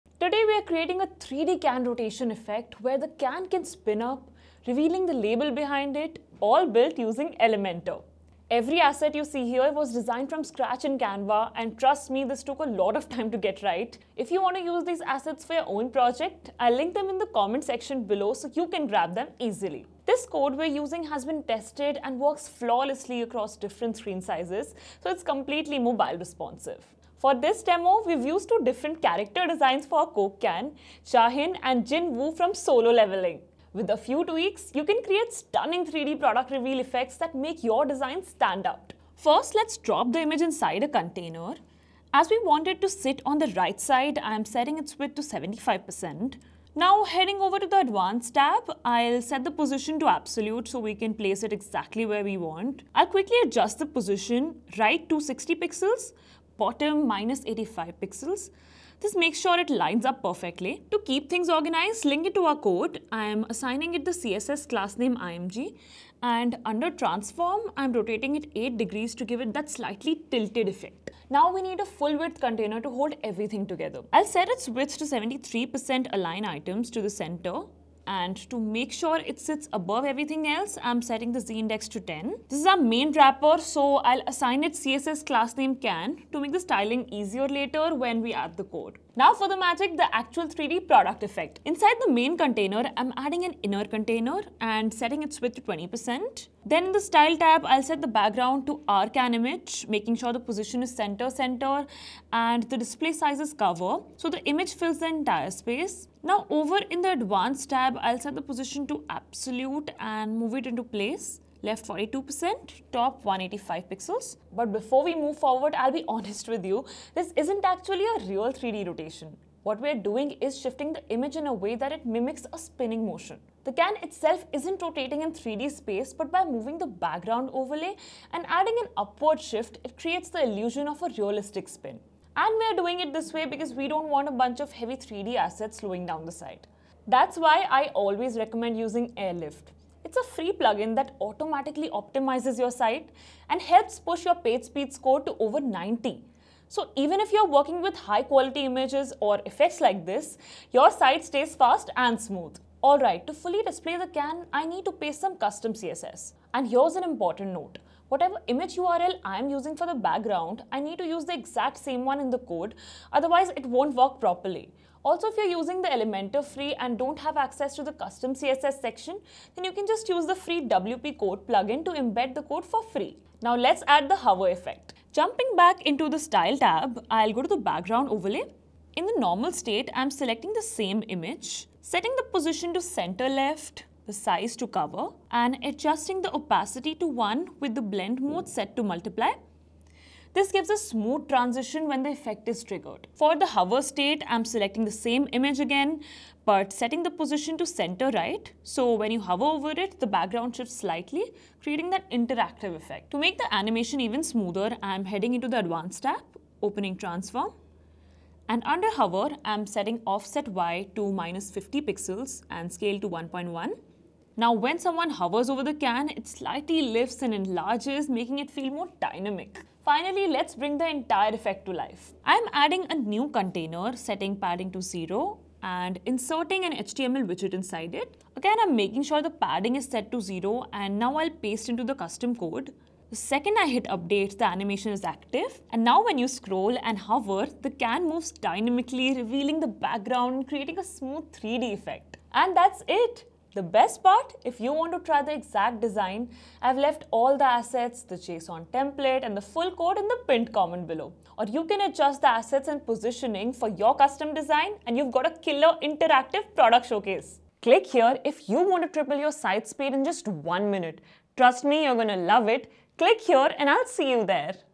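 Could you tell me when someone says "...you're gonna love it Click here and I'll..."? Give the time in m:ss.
4:21.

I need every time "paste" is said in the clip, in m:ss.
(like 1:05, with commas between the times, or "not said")
2:34, 3:51.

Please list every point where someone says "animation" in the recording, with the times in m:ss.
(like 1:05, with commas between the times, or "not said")
3:23, 3:54.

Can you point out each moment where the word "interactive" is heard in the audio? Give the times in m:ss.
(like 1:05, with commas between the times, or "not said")
3:22, 4:15.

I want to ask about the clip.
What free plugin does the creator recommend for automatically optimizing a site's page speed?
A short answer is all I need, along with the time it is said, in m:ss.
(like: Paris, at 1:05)
Airlift, at 2:19.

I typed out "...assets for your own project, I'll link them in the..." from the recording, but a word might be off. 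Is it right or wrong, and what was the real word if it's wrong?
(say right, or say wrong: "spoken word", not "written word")
right.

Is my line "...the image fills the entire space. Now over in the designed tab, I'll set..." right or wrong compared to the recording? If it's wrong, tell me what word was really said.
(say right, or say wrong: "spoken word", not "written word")
wrong: "advanced", not "designed".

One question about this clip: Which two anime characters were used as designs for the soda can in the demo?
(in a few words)
Cha Hae-in and Jin Woo.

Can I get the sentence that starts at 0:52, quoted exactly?
I'll quickly adjust the position, right to 60 pixels, bottom minus 85 pixels.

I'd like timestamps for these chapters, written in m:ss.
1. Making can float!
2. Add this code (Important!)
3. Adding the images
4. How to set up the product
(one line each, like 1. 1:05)
1. 2:53
2. 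3:43
3. 0:40
4. 1:31.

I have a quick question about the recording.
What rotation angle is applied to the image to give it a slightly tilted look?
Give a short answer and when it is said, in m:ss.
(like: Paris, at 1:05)
8 degrees, at 1:08.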